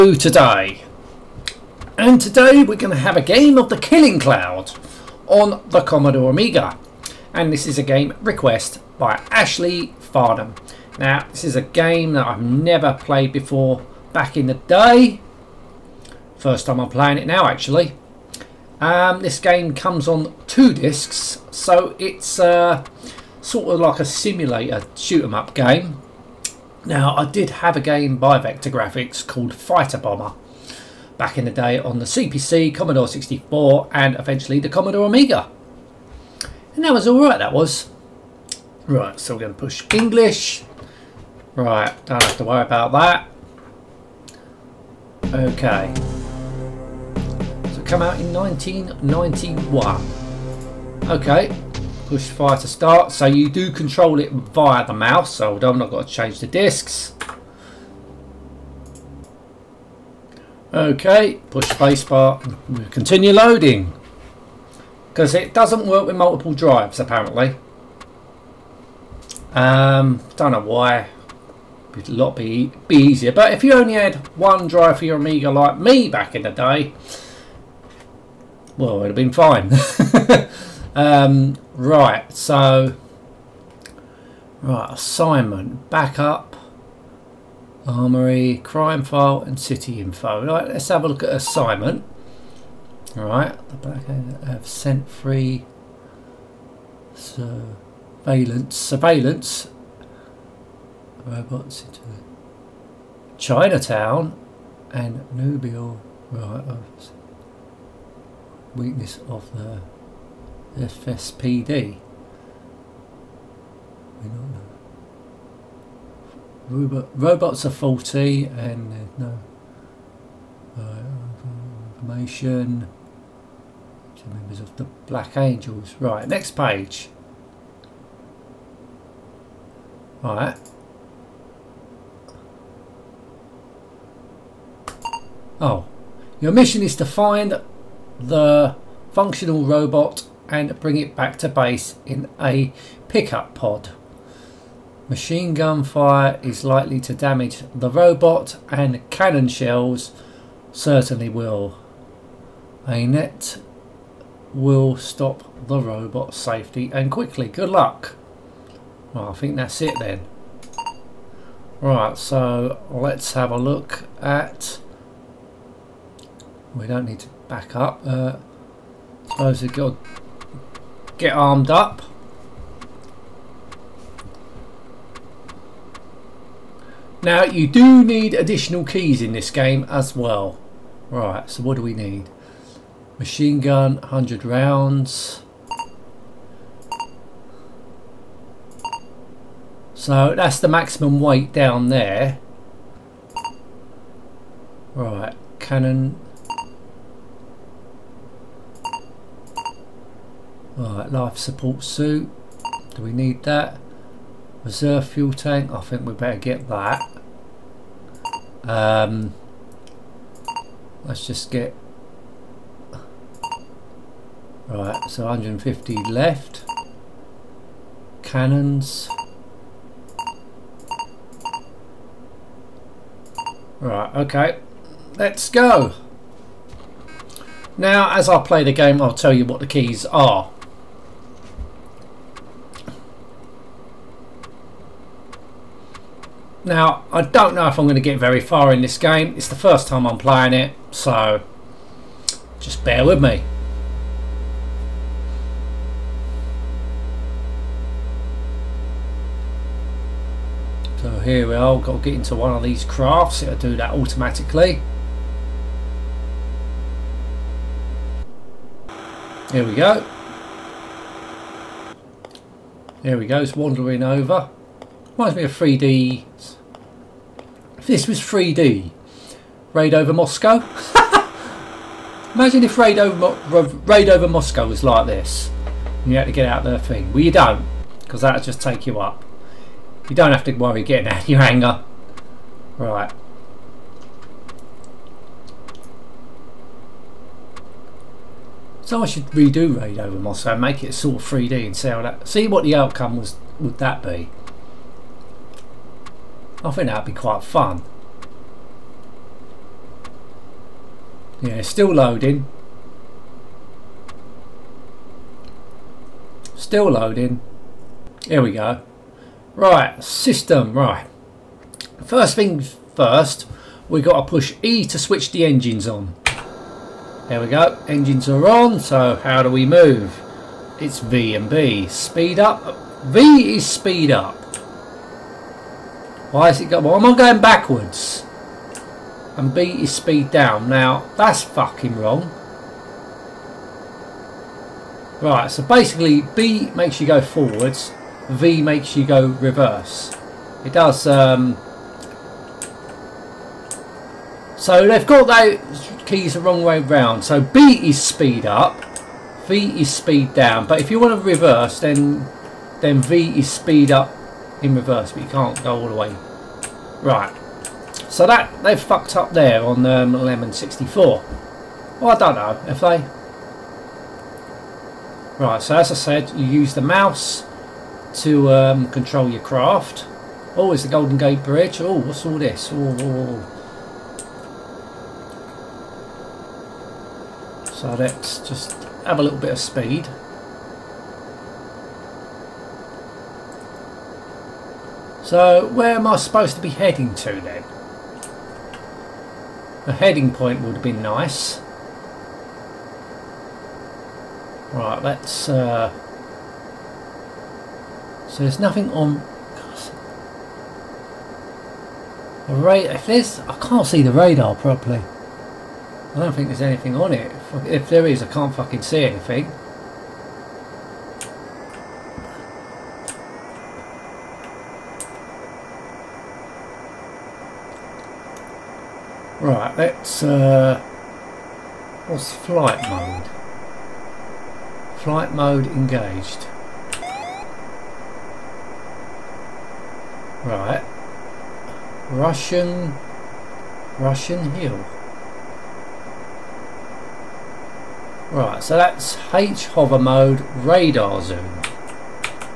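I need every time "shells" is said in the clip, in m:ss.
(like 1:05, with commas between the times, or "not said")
2:29.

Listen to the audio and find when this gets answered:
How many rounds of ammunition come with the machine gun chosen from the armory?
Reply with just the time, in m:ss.
3:03.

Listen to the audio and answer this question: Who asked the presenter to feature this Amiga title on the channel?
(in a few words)
Ashley Farnham.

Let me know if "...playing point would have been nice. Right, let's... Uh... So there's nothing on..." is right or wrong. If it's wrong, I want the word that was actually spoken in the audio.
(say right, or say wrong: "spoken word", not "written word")
wrong: "heading", not "playing".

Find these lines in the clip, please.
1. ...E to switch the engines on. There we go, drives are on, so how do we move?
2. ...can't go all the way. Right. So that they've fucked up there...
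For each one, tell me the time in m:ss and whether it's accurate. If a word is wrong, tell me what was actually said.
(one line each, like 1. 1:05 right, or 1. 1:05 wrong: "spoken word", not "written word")
1. 5:14 wrong: "engines", not "drives"
2. 5:55 right.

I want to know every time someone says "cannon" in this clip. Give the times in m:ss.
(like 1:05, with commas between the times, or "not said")
2:29, 3:15, 3:38.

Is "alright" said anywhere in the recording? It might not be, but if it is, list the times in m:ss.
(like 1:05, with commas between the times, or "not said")
0:37, 3:20.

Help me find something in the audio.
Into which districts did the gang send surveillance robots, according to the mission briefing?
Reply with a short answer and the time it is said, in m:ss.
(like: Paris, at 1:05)
Chinatown and Nob Hill, at 1:43.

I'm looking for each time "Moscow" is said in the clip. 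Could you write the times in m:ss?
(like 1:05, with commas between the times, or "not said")
4:30, 4:34, 4:50.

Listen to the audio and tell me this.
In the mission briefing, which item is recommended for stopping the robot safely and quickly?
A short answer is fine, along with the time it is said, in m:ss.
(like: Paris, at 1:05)
A net, at 2:32.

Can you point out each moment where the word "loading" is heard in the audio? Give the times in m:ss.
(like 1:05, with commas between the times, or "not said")
1:03, 5:01, 5:06.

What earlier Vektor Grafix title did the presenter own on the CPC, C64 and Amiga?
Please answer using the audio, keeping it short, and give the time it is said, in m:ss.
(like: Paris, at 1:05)
Fighter Bomber, at 0:29.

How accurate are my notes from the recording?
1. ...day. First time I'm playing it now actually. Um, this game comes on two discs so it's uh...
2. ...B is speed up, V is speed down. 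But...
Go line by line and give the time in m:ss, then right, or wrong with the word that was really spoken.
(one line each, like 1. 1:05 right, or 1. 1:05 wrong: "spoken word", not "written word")
1. 0:14 right
2. 5:47 right.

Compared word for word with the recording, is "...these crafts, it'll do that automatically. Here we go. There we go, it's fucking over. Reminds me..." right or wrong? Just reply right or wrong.
wrong.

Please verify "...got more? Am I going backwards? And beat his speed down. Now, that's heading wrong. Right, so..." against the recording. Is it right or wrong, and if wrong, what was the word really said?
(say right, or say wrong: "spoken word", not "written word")
wrong: "fucking", not "heading".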